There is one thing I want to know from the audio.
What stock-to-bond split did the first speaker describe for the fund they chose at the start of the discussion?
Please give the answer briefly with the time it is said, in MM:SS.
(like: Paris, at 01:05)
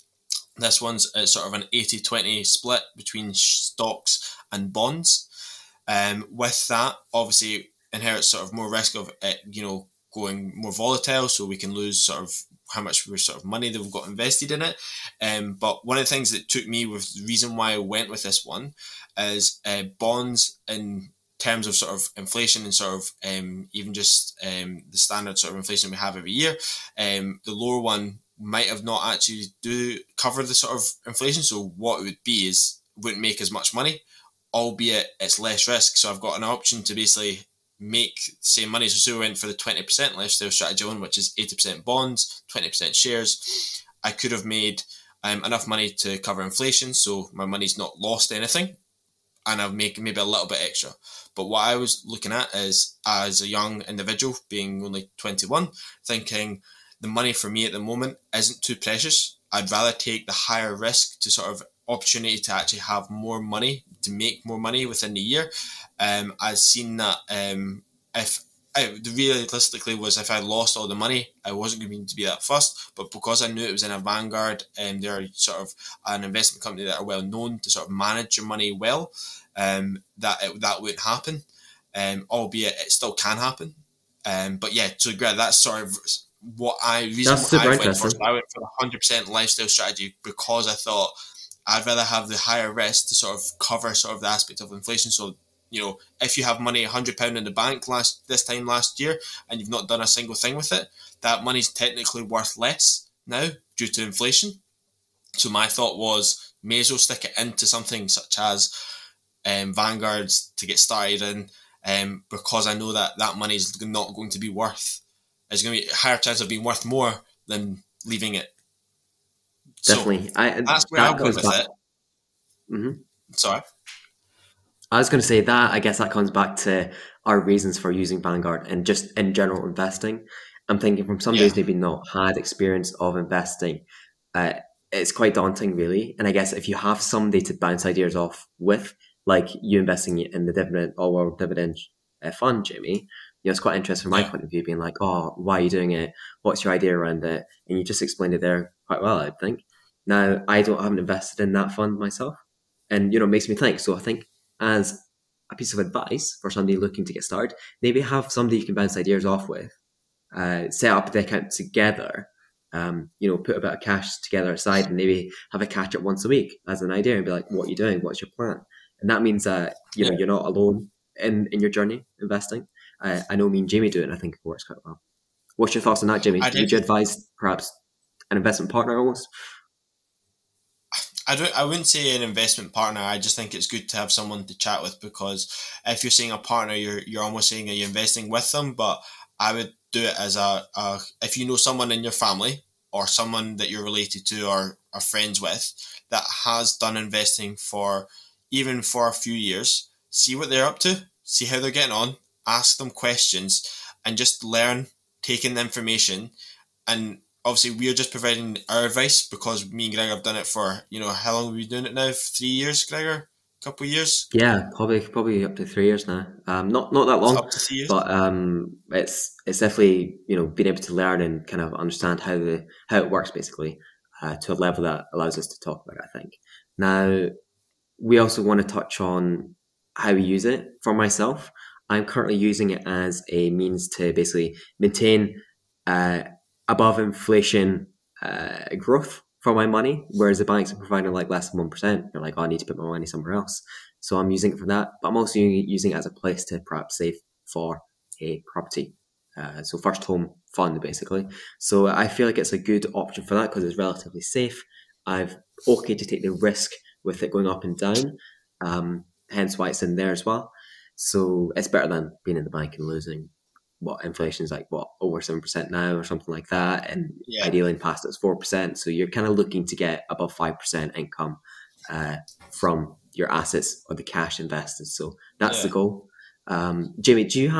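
80/20, at 00:01.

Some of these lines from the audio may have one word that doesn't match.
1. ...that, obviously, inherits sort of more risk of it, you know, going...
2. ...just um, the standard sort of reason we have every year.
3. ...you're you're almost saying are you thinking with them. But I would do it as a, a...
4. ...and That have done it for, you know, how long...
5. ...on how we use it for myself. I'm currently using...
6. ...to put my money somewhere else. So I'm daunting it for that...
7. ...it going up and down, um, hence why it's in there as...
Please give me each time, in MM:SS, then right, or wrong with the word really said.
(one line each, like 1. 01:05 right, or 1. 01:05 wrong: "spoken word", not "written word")
1. 00:06 right
2. 00:23 wrong: "inflation", not "reason"
3. 03:06 wrong: "investing", not "thinking"
4. 03:29 wrong: "Gregor", not "That"
5. 03:49 right
6. 04:02 wrong: "using", not "daunting"
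7. 04:17 right.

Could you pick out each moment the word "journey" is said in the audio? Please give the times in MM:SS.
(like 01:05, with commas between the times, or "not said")
02:51.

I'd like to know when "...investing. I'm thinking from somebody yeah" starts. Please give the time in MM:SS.
02:09.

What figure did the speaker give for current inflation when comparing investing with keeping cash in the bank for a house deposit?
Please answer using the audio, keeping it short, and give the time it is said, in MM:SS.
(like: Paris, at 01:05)
over 7%, at 04:24.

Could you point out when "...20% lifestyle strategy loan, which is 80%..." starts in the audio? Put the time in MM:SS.
00:39.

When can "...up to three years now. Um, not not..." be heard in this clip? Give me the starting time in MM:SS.
03:35.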